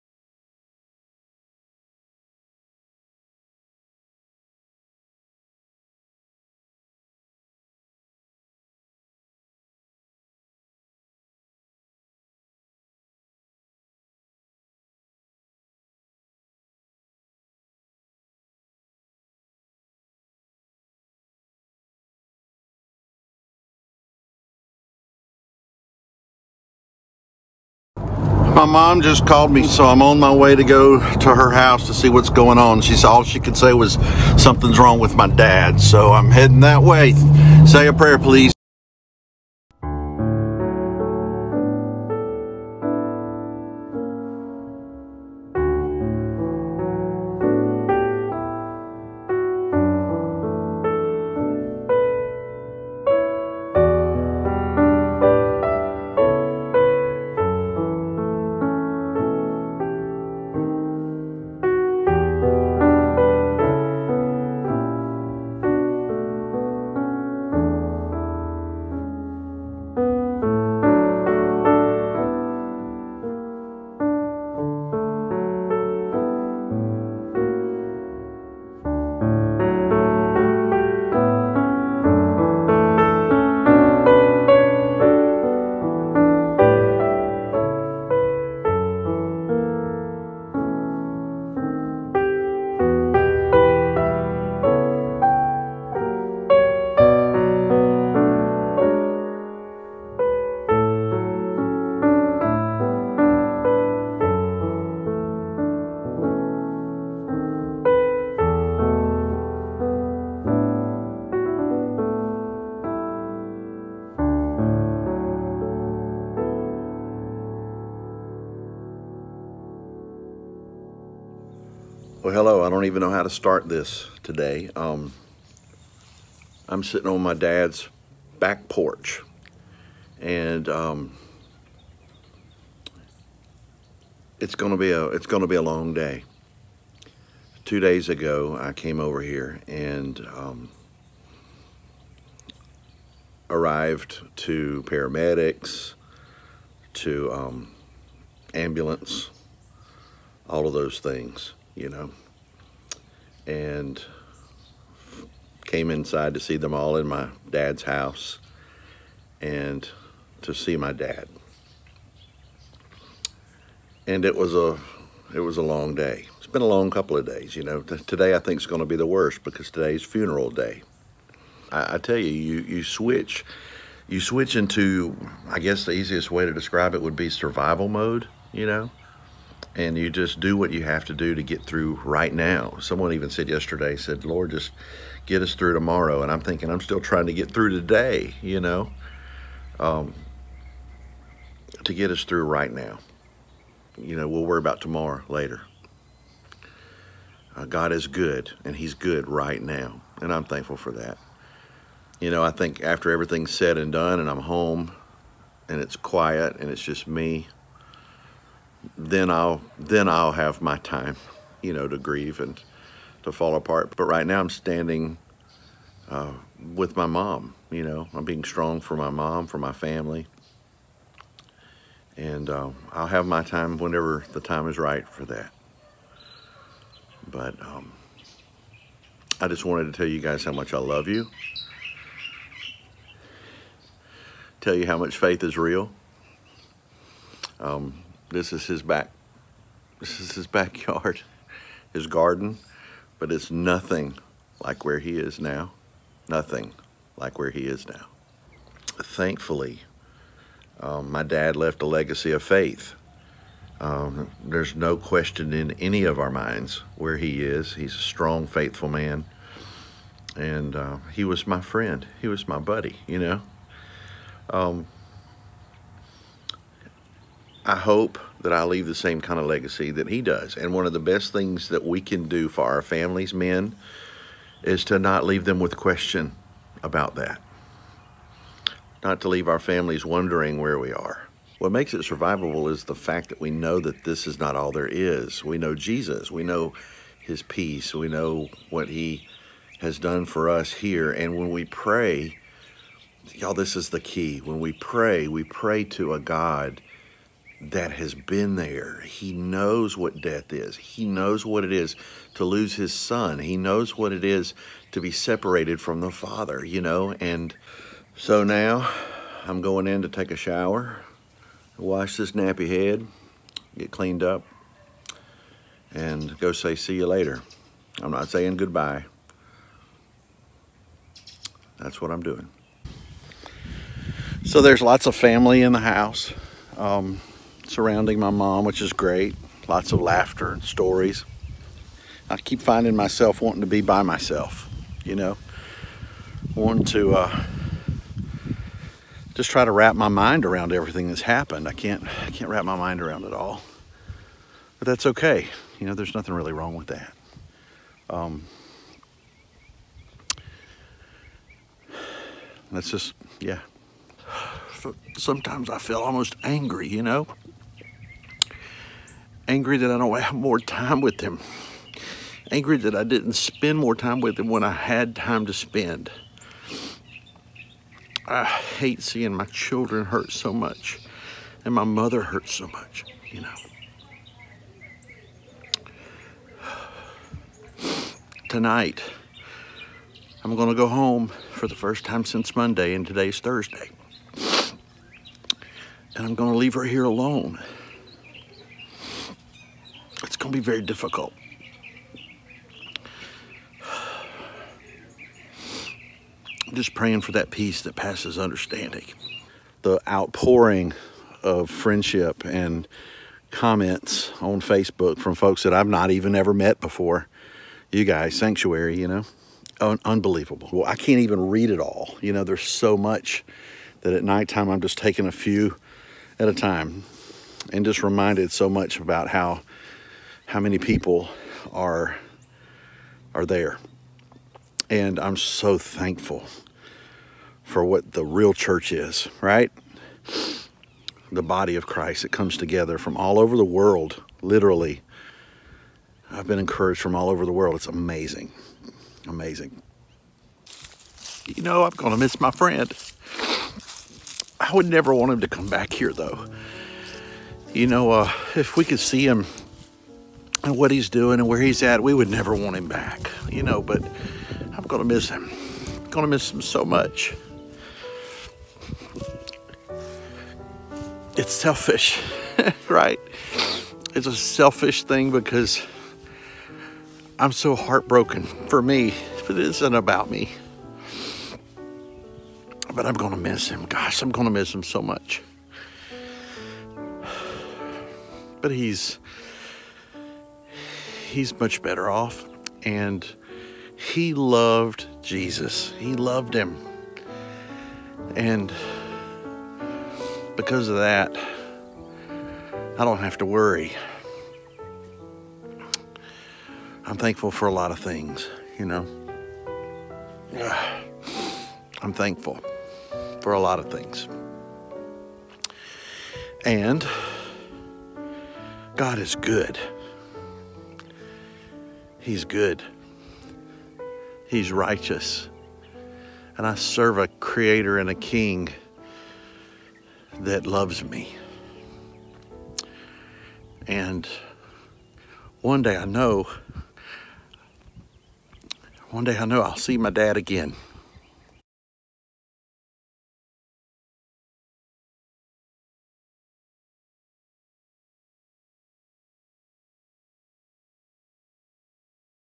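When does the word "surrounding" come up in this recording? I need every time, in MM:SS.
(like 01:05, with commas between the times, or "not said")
05:27.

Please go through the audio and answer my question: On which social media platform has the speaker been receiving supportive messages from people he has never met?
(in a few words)
Facebook.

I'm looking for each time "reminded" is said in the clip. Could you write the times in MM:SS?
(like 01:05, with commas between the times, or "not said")
06:58.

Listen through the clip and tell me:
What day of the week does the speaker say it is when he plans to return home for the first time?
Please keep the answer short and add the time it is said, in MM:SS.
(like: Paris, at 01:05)
Thursday, at 06:23.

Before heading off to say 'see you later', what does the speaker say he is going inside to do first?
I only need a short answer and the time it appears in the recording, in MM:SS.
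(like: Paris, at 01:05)
take a shower, at 05:10.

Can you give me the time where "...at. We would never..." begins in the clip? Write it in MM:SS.
07:31.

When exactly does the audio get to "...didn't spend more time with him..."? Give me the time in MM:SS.
06:03.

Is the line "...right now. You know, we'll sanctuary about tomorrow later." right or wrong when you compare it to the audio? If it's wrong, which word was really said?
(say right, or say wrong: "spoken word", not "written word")
wrong: "worry", not "sanctuary".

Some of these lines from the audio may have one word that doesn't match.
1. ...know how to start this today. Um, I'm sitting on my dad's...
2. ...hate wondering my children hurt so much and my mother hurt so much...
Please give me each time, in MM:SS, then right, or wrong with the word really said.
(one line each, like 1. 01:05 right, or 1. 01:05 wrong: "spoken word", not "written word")
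1. 02:02 right
2. 06:08 wrong: "seeing", not "wondering".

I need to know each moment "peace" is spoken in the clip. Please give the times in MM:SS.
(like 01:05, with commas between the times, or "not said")
04:47, 06:37.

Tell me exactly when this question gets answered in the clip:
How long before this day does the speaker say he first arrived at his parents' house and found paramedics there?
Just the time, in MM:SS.
02:17.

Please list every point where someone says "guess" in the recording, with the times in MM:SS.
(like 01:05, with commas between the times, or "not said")
02:55.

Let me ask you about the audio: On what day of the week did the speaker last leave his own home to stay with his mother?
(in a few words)
Monday.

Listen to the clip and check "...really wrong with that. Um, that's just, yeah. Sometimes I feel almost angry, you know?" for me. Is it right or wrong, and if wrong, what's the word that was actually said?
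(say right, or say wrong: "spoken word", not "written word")
right.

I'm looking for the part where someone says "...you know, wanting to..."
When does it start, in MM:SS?
05:35.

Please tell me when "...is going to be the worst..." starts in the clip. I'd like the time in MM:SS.
02:48.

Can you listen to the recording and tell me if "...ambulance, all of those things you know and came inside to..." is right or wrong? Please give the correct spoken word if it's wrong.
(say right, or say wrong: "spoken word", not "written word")
right.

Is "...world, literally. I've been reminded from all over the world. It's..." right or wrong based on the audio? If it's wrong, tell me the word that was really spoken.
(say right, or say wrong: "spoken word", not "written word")
wrong: "encouraged", not "reminded".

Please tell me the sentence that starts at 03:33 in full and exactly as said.
But right now I'm standing uh, with my mom.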